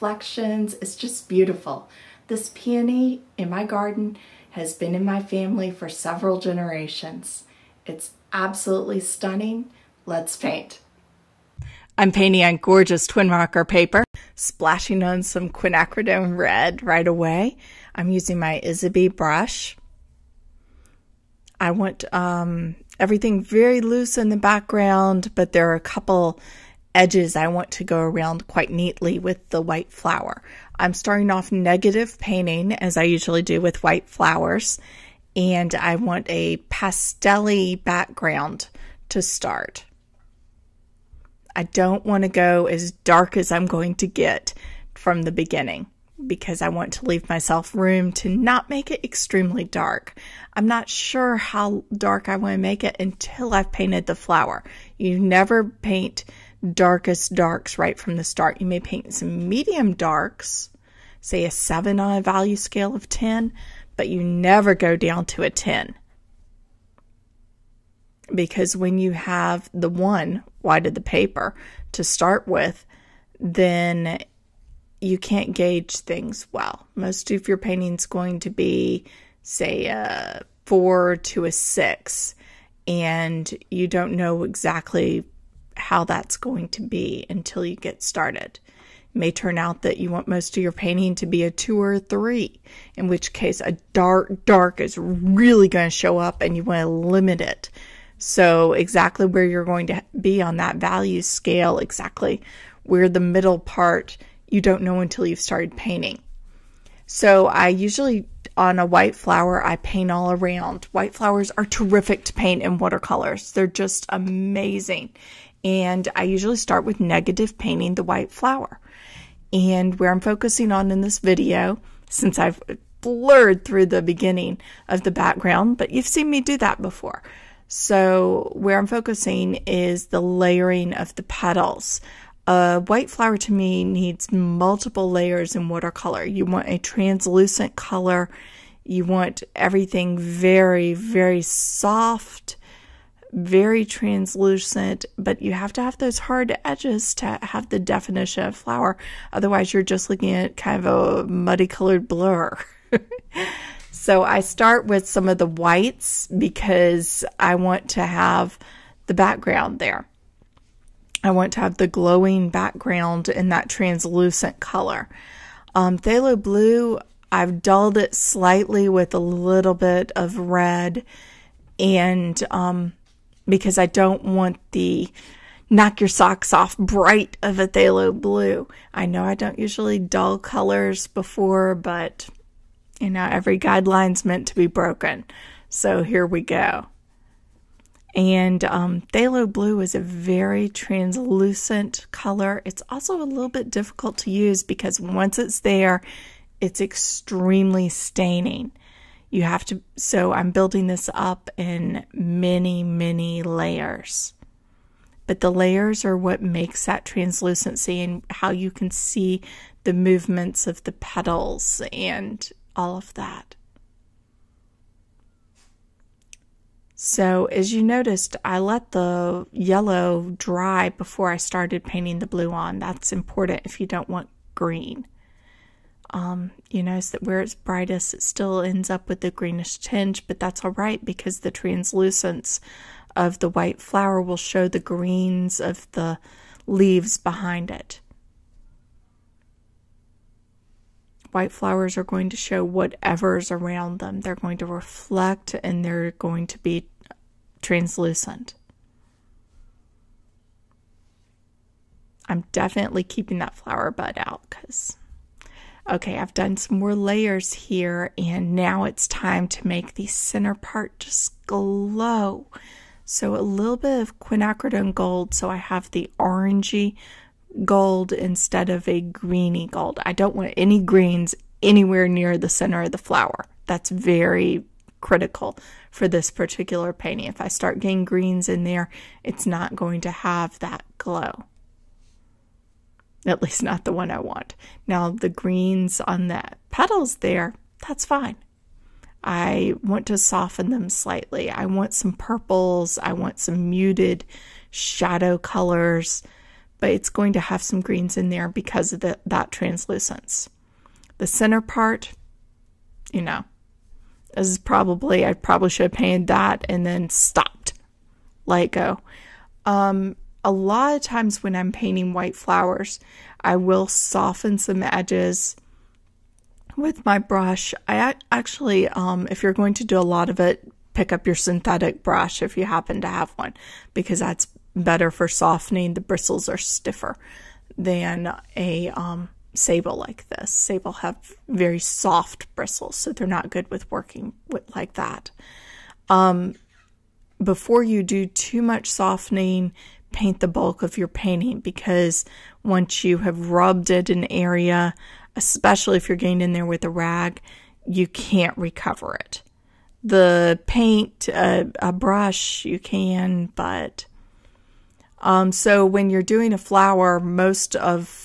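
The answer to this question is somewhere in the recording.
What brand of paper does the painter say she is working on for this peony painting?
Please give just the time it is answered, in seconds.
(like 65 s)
13 s.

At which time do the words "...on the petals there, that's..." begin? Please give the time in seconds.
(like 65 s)
286 s.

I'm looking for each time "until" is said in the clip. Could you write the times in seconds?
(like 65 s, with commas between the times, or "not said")
52 s, 87 s, 104 s.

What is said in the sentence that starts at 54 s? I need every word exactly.
You never paint darkest darks right from the start.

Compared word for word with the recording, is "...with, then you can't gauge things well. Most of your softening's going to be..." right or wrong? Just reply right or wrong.
wrong.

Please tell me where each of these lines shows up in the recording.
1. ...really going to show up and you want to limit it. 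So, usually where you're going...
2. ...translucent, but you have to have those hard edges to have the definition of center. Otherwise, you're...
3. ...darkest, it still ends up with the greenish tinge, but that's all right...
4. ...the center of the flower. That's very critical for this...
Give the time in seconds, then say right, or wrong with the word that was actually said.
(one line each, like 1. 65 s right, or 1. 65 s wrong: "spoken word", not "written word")
1. 94 s wrong: "exactly", not "usually"
2. 143 s wrong: "flower", not "center"
3. 227 s wrong: "brightest", not "darkest"
4. 272 s right.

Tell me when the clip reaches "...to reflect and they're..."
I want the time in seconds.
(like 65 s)
244 s.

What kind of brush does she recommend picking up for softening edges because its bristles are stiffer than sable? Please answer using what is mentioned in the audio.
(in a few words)
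synthetic brush.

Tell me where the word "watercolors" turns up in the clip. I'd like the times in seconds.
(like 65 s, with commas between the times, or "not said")
112 s, 135 s.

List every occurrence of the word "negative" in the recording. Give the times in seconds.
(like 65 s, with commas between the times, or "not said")
31 s, 116 s.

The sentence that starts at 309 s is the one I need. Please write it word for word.
Um, a lot of times when I'm painting white flowers, I will soften some edges with my brush.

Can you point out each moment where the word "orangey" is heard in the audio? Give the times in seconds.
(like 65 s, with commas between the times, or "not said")
266 s.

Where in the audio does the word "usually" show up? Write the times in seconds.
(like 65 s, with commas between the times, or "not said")
33 s, 107 s, 116 s, 179 s.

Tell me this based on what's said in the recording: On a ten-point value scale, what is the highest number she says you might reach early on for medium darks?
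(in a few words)
7.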